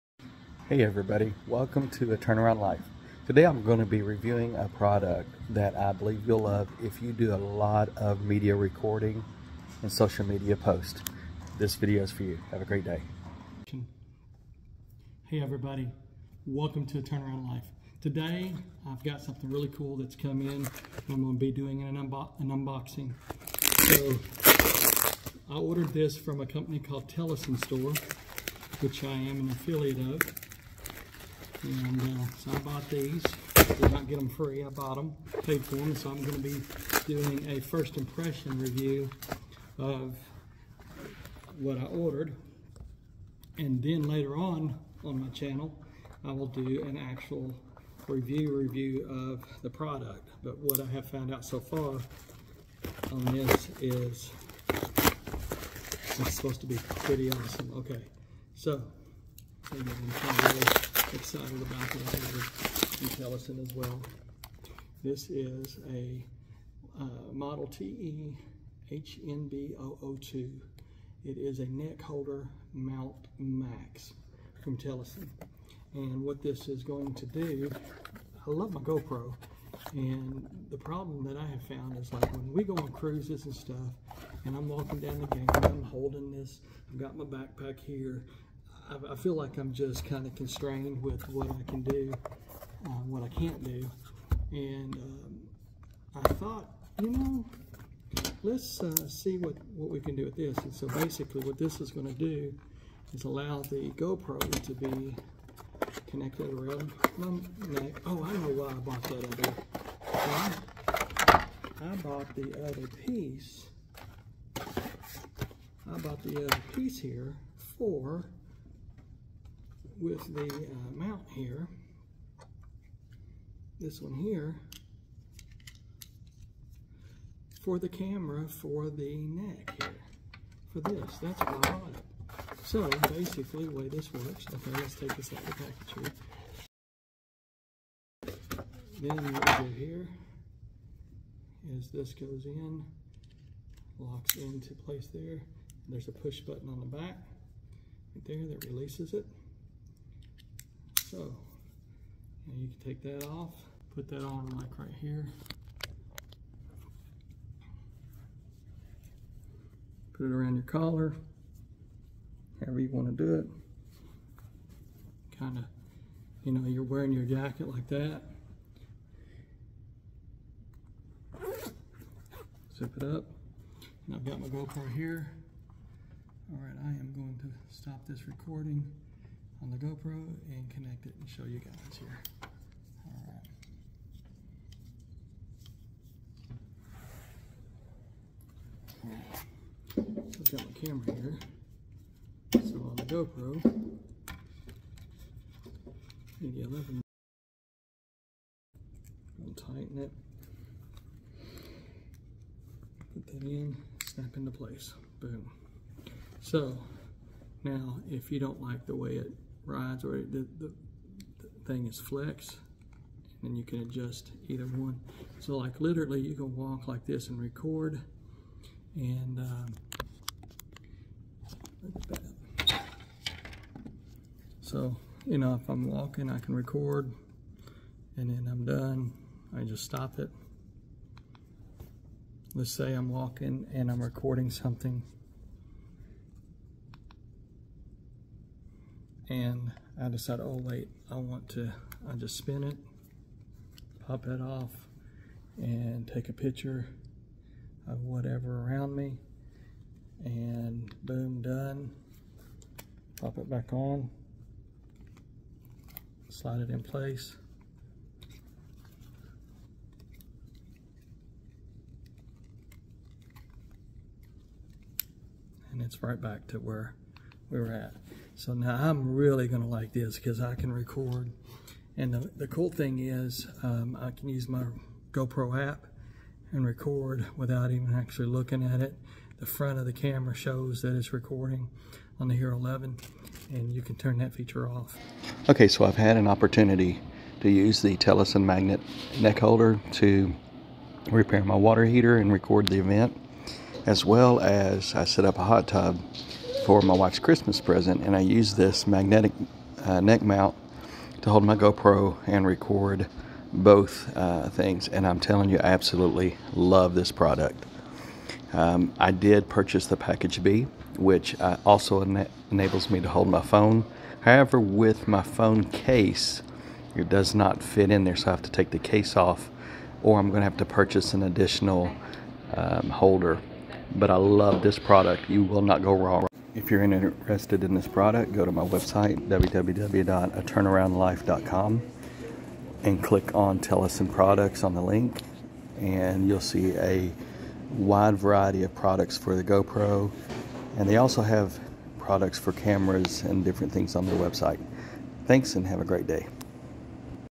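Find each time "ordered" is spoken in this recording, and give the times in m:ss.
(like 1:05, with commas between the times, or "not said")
0:25, 0:41.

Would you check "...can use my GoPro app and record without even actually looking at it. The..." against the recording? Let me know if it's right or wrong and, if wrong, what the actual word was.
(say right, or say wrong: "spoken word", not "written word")
right.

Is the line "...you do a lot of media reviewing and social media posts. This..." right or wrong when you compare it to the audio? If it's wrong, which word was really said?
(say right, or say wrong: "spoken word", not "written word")
wrong: "recording", not "reviewing".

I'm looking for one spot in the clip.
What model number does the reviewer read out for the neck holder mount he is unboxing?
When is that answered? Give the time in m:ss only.
1:07.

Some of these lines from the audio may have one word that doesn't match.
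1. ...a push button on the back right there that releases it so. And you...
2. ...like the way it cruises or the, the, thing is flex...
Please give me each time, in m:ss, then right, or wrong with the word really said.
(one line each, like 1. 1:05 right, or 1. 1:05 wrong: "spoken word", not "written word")
1. 2:26 right
2. 3:28 wrong: "rides", not "cruises".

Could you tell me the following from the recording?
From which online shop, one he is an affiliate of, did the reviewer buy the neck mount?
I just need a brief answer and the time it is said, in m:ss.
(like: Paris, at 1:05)
Telesin Store, at 0:27.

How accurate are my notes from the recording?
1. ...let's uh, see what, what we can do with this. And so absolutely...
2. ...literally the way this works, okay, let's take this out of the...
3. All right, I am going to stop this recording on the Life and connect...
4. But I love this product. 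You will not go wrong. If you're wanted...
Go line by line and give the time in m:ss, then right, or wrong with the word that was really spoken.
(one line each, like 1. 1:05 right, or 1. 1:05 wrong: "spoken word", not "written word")
1. 1:38 wrong: "basically", not "absolutely"
2. 2:13 wrong: "basically", not "literally"
3. 2:56 wrong: "GoPro", not "Life"
4. 5:23 wrong: "interested", not "wanted".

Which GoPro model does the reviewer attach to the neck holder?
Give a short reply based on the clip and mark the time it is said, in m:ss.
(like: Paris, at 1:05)
11, at 3:16.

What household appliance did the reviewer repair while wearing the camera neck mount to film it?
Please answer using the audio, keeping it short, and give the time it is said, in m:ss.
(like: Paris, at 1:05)
water heater, at 4:51.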